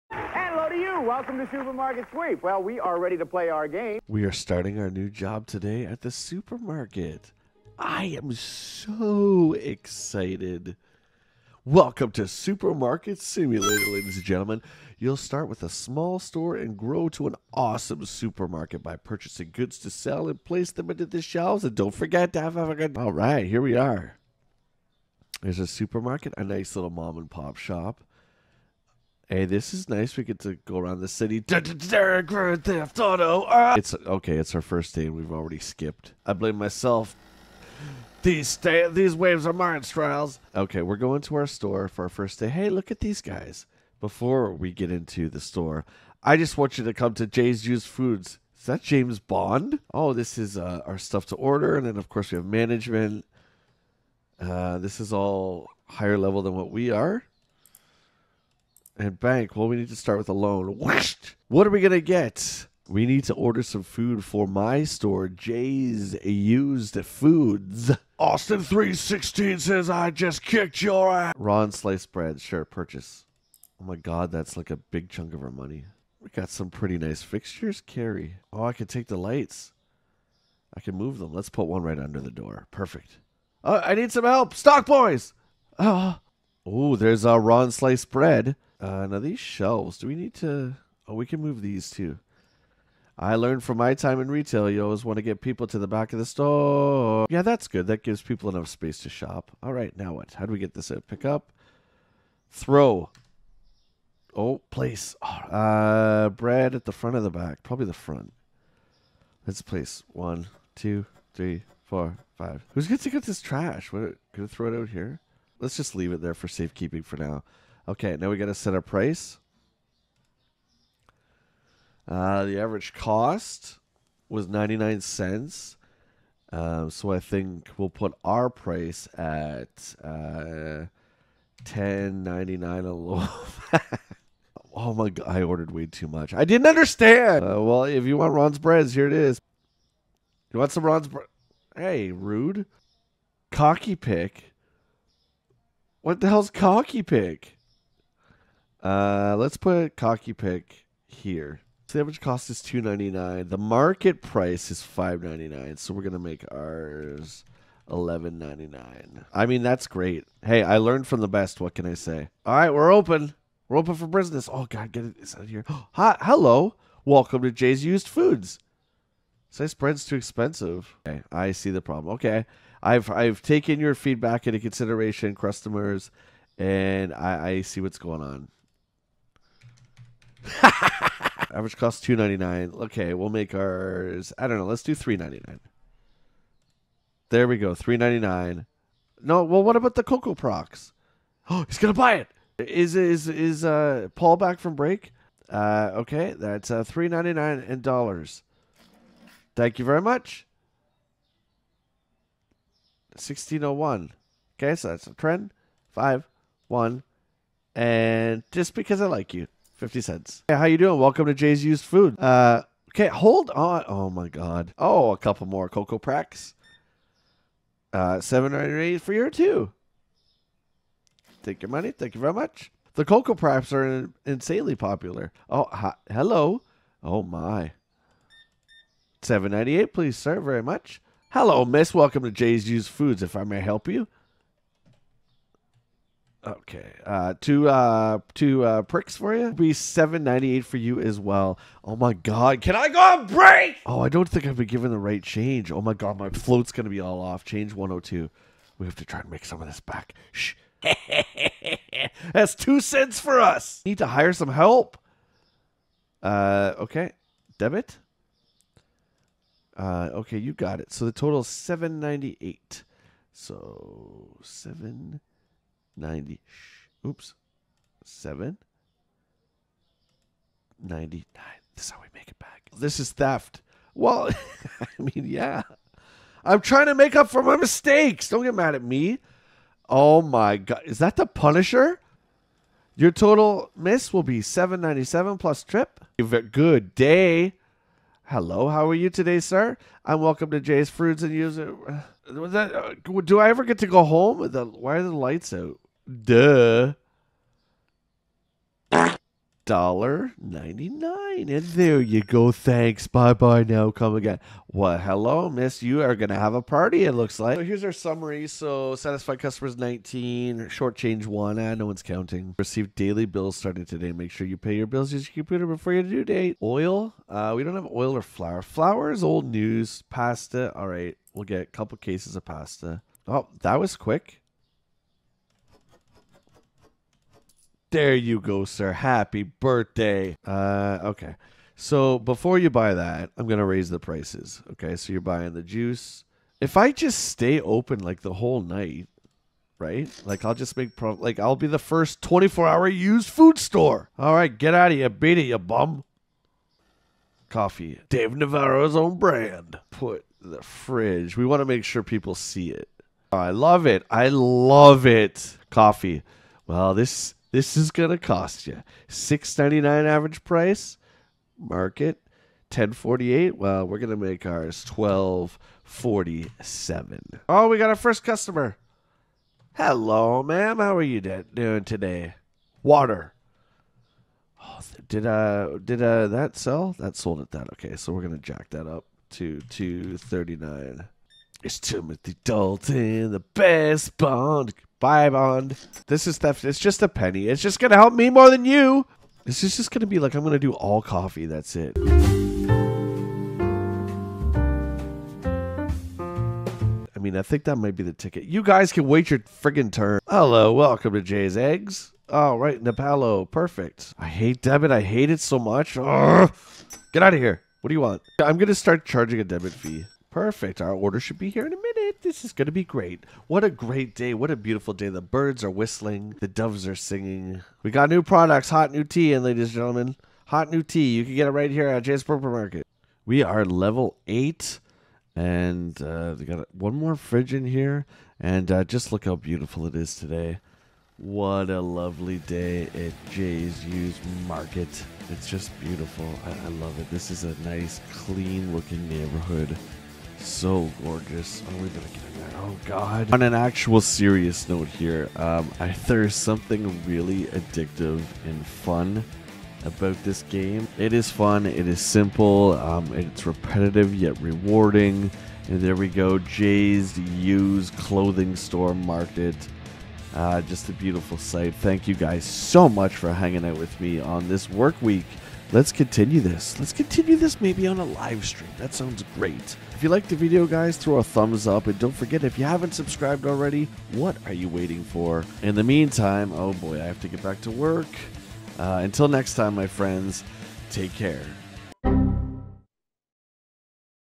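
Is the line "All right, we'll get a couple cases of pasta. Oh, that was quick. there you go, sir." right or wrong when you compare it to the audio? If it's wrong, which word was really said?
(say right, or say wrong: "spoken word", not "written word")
right.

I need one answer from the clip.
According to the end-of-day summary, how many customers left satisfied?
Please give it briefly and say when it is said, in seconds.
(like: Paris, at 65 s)
19, at 309 s.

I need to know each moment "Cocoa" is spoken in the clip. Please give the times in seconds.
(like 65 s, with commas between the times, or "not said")
190 s, 215 s, 223 s.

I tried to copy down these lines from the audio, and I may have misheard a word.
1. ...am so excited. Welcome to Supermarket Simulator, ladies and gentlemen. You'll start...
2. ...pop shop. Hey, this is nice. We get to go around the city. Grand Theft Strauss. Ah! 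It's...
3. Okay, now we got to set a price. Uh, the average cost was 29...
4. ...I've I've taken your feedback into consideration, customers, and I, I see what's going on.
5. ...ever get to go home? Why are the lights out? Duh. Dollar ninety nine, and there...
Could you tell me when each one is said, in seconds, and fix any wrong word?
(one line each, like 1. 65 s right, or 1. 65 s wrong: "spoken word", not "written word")
1. 8 s right
2. 27 s wrong: "Auto", not "Strauss"
3. 117 s wrong: "99", not "29"
4. 172 s right
5. 293 s right.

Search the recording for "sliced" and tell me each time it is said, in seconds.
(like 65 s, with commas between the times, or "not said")
71 s, 87 s, 169 s.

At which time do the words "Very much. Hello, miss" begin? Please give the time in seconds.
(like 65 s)
230 s.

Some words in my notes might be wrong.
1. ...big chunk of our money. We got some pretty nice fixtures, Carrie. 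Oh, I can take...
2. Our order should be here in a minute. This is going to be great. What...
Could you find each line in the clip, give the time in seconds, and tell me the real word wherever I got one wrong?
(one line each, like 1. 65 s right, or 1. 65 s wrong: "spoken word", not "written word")
1. 74 s right
2. 410 s right.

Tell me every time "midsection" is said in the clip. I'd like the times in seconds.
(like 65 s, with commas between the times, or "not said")
not said.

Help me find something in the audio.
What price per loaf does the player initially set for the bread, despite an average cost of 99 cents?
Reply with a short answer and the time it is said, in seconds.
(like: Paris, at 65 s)
$10.99, at 131 s.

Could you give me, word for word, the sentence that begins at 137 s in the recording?
Uh, well, if you want Ron's breads, here it is.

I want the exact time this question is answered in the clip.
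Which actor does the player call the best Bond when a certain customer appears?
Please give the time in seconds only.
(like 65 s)
381 s.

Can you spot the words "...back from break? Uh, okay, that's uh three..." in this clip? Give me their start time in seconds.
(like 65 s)
194 s.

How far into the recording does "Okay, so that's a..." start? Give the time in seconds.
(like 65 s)
204 s.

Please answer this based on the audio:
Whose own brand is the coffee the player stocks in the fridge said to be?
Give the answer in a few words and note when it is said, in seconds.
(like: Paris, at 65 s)
Dave Navarro, at 348 s.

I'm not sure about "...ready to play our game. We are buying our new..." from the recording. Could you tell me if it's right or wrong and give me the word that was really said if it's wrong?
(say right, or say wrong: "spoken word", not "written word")
wrong: "starting", not "buying".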